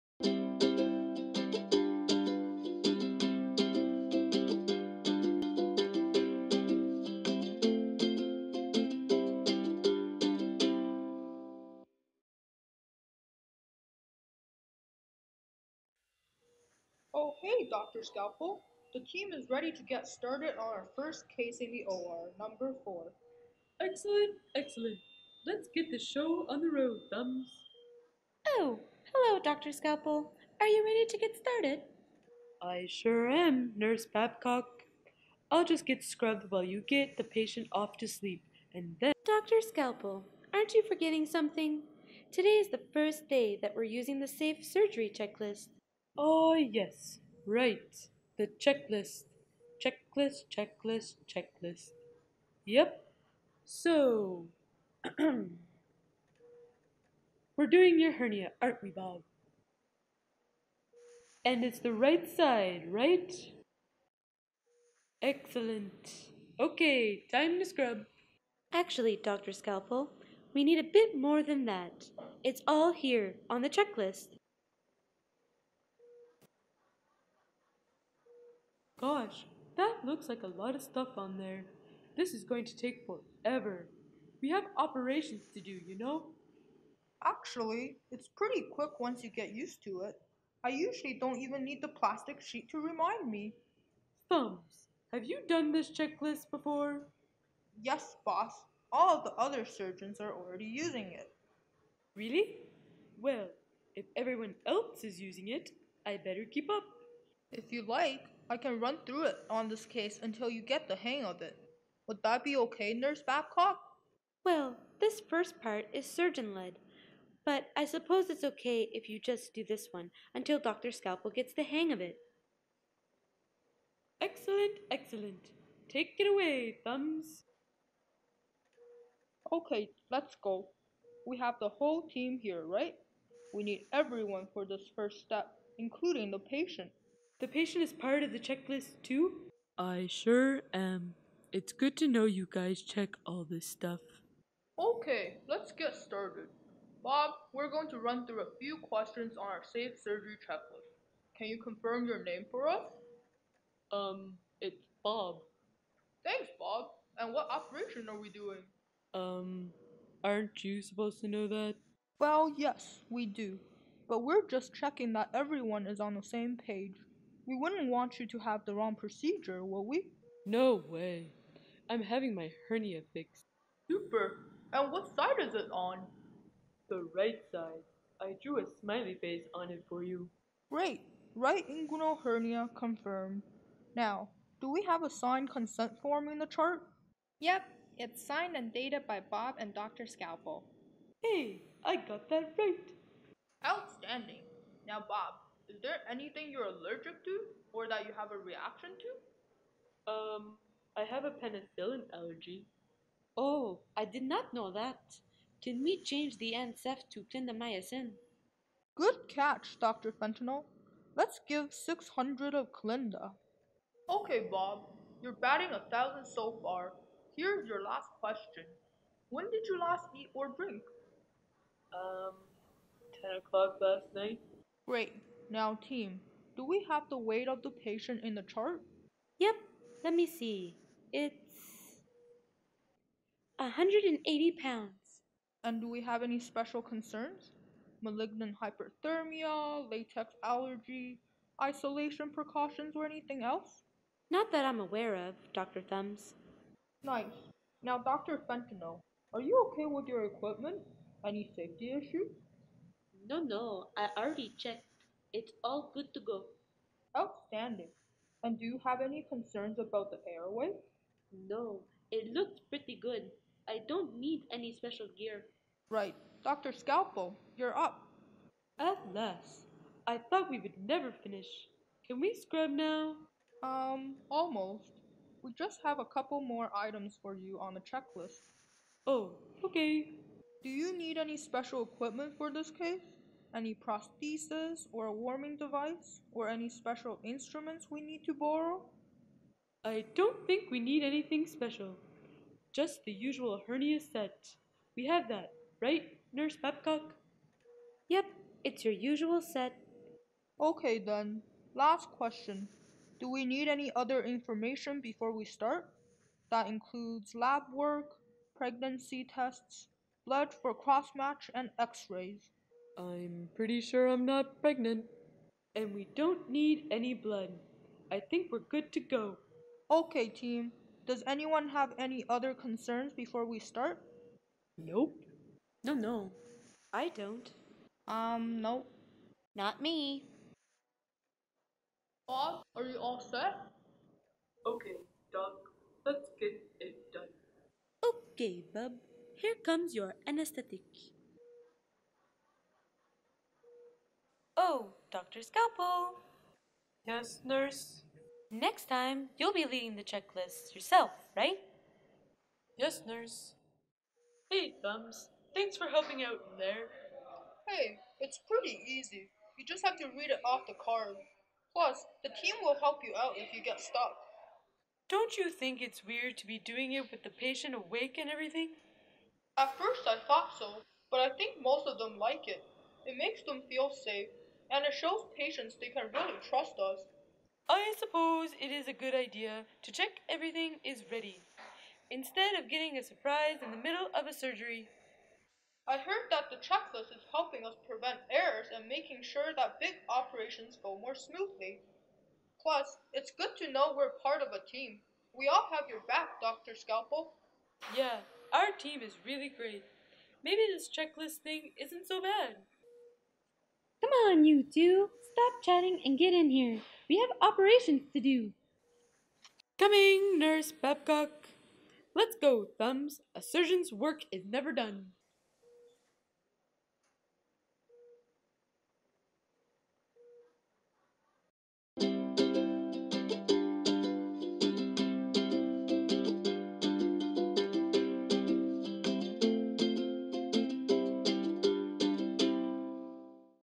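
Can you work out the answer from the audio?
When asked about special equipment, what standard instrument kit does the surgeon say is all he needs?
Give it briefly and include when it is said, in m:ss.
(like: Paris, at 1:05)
usual hernia set, at 4:53.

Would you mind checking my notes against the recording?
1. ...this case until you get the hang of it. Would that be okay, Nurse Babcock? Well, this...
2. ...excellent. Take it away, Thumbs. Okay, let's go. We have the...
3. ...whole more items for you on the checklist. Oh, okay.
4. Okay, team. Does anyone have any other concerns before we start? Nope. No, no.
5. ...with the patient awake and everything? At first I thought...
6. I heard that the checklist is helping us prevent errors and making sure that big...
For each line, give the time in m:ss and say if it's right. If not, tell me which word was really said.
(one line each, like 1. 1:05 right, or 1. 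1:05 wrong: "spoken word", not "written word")
1. 1:49 right
2. 2:04 right
3. 4:36 wrong: "couple", not "whole"
4. 5:19 right
5. 6:07 right
6. 6:25 right.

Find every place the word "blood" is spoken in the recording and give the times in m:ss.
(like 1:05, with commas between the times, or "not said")
5:10, 5:17.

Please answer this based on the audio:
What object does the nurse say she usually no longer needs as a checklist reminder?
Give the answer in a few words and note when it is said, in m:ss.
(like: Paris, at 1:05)
plastic sheet, at 1:31.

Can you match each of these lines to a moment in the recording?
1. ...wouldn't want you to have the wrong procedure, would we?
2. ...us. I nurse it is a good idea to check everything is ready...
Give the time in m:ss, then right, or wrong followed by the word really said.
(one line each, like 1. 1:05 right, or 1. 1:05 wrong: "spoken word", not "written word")
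1. 2:47 right
2. 6:16 wrong: "suppose", not "nurse".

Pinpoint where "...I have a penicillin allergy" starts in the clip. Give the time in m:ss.
3:20.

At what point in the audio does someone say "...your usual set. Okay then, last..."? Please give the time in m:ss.
4:58.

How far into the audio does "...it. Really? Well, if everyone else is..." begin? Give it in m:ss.
1:41.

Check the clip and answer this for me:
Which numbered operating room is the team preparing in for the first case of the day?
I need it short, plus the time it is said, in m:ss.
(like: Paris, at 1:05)
4, at 0:22.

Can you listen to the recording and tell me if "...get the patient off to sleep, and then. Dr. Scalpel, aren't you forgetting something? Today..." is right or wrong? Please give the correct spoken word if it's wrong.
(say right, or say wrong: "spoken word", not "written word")
right.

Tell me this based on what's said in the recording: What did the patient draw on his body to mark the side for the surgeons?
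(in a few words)
a smiley face.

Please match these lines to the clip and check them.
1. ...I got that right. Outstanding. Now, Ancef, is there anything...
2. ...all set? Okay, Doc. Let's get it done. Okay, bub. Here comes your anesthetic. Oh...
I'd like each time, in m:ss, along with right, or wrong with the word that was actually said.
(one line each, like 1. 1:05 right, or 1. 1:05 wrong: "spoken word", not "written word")
1. 3:11 wrong: "Bob", not "Ancef"
2. 5:32 right.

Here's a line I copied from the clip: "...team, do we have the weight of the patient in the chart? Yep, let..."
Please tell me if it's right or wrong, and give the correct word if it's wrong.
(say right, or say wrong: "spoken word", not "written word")
right.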